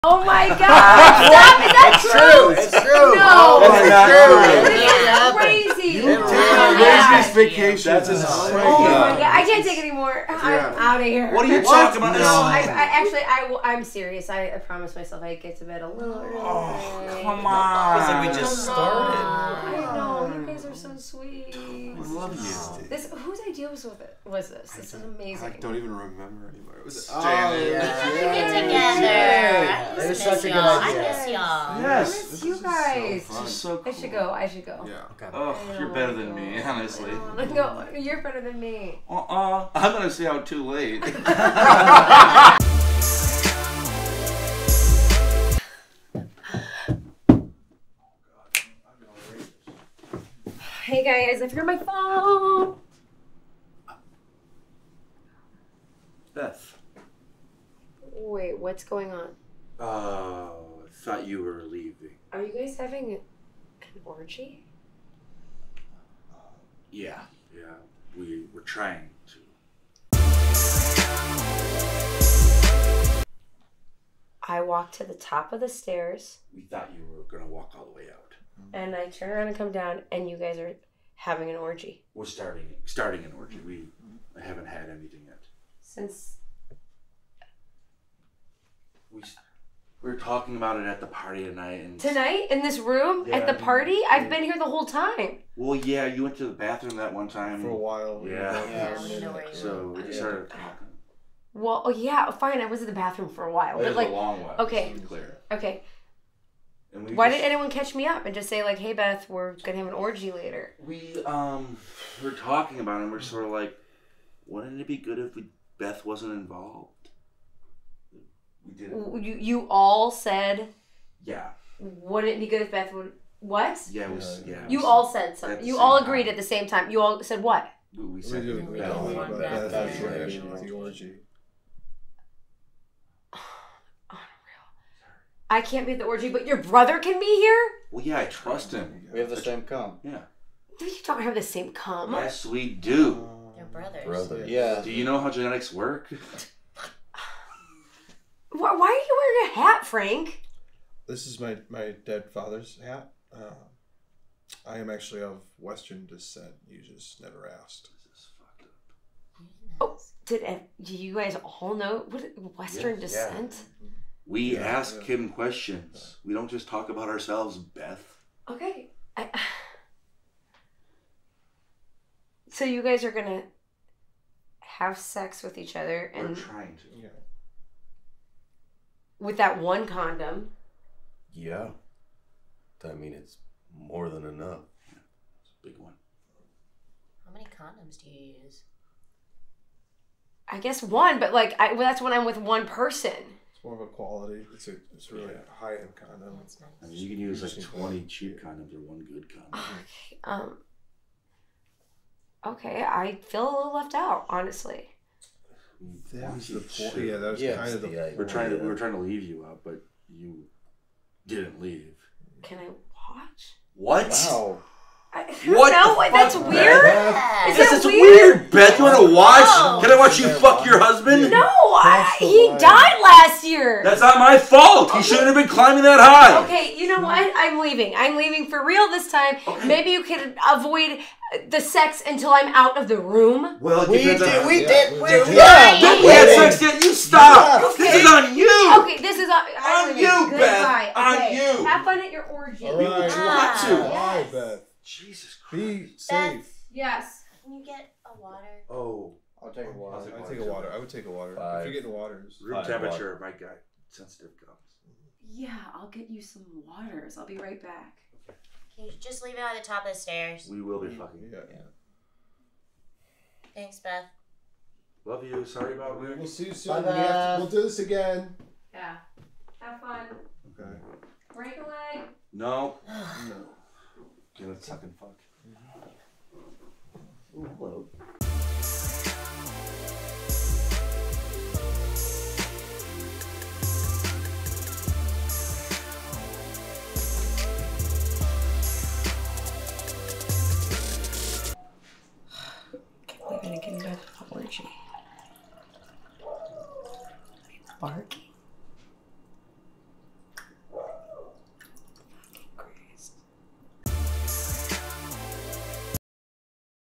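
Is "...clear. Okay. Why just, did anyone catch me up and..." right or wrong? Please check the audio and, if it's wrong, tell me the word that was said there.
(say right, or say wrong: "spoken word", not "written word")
right.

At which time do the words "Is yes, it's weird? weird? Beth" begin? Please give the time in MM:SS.
03:37.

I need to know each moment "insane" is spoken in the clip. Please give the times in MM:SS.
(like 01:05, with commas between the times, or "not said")
00:08.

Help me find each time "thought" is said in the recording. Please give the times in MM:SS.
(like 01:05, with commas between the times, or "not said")
01:01, 01:16.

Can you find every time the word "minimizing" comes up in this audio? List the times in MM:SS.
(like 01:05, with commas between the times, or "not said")
not said.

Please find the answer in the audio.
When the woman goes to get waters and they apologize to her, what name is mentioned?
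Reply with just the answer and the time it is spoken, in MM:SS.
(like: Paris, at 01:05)
Rick, at 04:25.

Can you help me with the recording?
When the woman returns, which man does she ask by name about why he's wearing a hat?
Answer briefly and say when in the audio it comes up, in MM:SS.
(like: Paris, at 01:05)
Frank, at 02:29.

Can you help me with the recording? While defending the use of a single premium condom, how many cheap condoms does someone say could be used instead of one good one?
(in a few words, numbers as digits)
20.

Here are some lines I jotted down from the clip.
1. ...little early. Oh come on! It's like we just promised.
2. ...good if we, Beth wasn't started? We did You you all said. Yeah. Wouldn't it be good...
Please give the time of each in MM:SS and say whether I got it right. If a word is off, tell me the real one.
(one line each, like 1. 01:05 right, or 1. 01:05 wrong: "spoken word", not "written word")
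1. 00:15 wrong: "started", not "promised"
2. 01:54 wrong: "involved", not "started".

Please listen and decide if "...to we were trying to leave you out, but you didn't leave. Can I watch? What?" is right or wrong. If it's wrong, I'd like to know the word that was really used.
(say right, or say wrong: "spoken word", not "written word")
right.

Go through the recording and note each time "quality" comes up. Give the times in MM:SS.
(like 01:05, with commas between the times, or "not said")
03:13.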